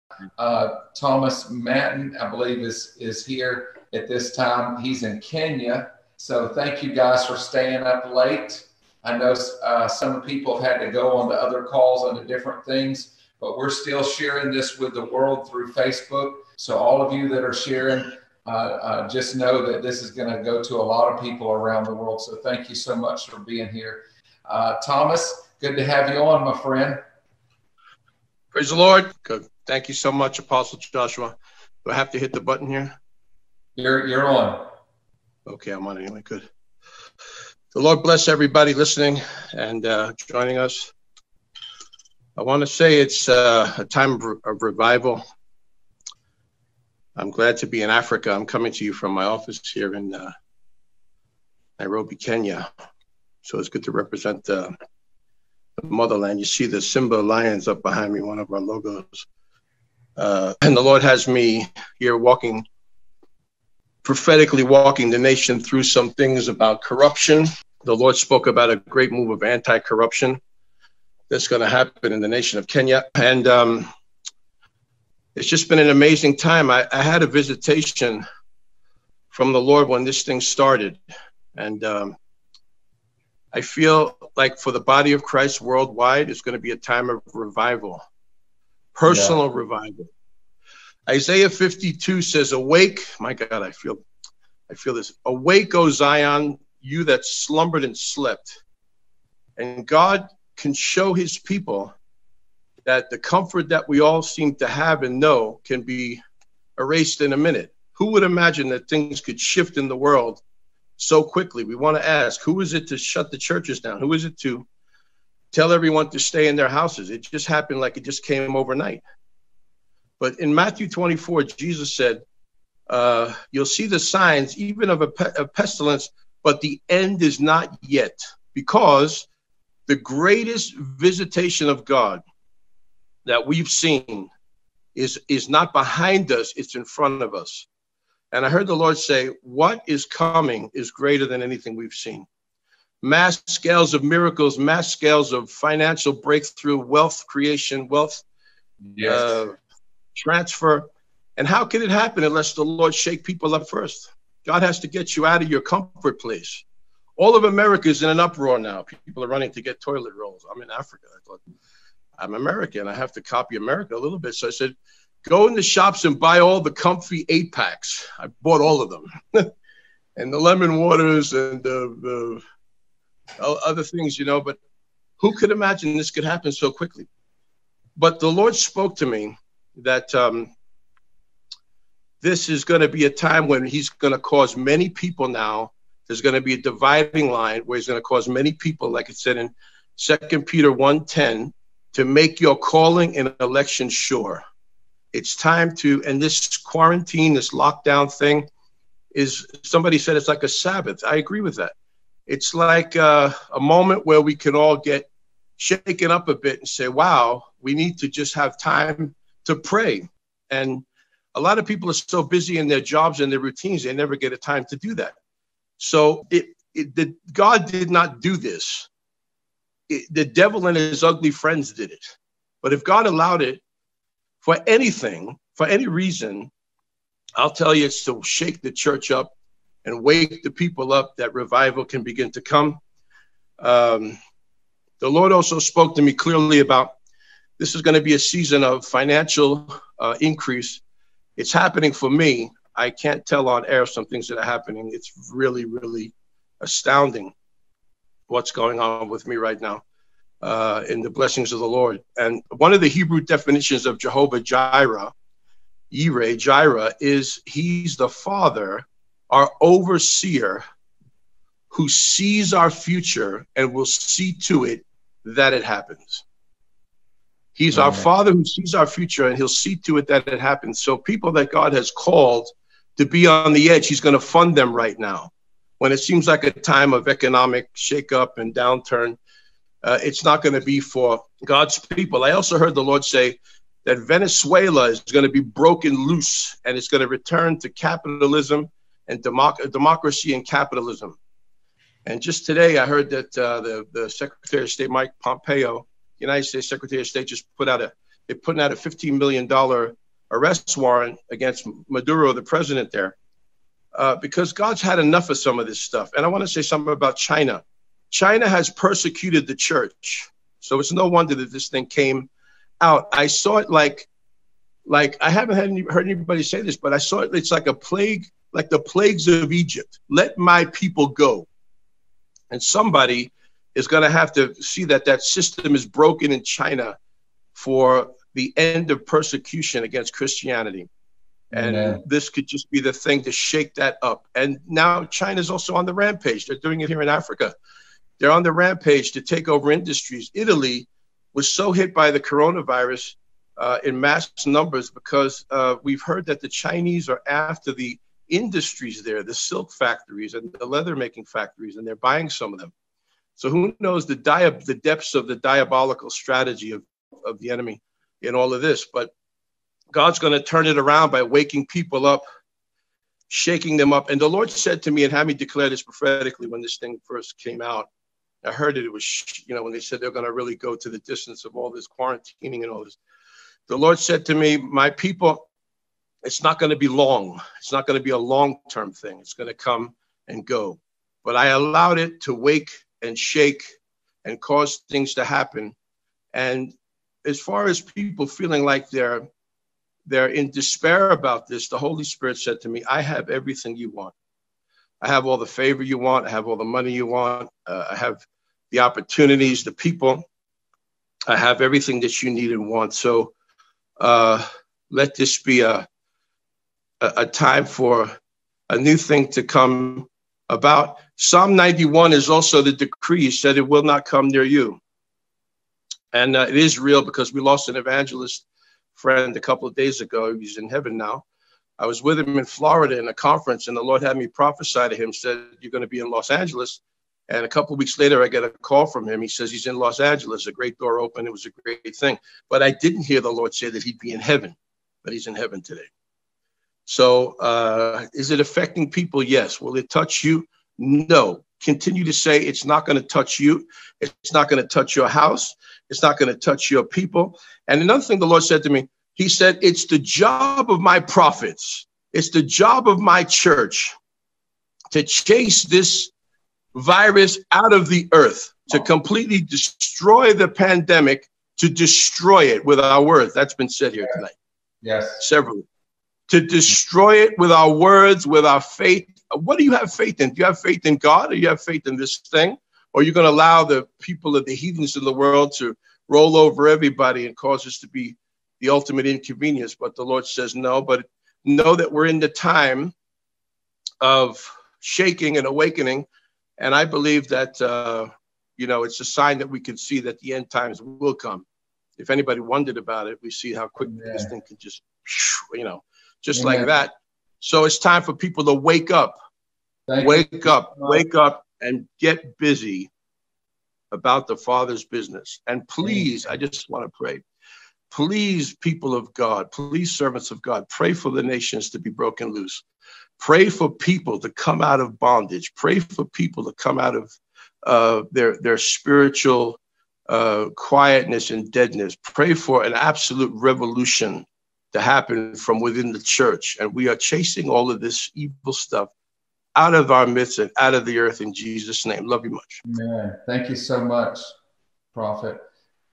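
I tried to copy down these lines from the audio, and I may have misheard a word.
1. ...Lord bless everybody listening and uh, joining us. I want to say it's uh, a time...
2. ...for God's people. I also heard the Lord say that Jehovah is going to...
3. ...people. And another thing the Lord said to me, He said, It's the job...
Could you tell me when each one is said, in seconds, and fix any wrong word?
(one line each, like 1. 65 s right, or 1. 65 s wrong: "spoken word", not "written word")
1. 37 s right
2. 280 s wrong: "Venezuela", not "Jehovah"
3. 446 s right.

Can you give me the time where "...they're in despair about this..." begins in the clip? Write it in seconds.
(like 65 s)
390 s.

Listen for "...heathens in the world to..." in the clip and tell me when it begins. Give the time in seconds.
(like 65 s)
474 s.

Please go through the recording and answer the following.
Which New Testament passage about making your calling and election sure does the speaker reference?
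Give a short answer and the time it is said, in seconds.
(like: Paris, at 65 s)
Second Peter 1:10, at 189 s.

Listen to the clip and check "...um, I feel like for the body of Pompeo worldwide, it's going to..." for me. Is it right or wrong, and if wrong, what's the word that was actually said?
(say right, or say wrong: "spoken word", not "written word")
wrong: "Christ", not "Pompeo".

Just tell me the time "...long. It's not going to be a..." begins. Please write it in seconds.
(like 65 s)
376 s.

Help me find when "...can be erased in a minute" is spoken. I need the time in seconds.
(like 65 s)
105 s.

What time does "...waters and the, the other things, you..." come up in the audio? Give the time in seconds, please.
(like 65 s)
170 s.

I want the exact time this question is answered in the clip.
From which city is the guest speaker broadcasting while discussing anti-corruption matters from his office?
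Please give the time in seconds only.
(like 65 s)
51 s.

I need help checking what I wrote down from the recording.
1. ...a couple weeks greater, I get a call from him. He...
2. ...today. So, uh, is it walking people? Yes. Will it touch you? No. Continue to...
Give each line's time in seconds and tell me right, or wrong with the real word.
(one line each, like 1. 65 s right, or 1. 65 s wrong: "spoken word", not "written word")
1. 427 s wrong: "later", not "greater"
2. 435 s wrong: "affecting", not "walking".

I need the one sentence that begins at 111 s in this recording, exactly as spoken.
We want to ask who is it to shut the churches down?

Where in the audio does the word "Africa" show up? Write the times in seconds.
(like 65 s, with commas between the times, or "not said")
47 s, 160 s, 337 s.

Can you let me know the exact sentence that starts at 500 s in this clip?
up, wake up, and get busy about the Father's business.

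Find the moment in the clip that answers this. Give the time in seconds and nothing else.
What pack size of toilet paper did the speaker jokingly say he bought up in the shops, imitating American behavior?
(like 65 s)
167 s.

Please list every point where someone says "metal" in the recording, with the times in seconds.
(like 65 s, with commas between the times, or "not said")
not said.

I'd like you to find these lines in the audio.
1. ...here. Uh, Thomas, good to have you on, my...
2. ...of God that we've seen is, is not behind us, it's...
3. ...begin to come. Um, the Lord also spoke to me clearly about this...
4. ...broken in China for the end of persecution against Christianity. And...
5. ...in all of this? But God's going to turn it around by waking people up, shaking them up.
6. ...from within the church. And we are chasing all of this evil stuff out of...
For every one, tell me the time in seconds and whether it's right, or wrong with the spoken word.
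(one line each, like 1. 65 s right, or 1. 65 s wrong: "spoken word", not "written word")
1. 23 s right
2. 131 s right
3. 232 s right
4. 325 s right
5. 358 s right
6. 525 s right.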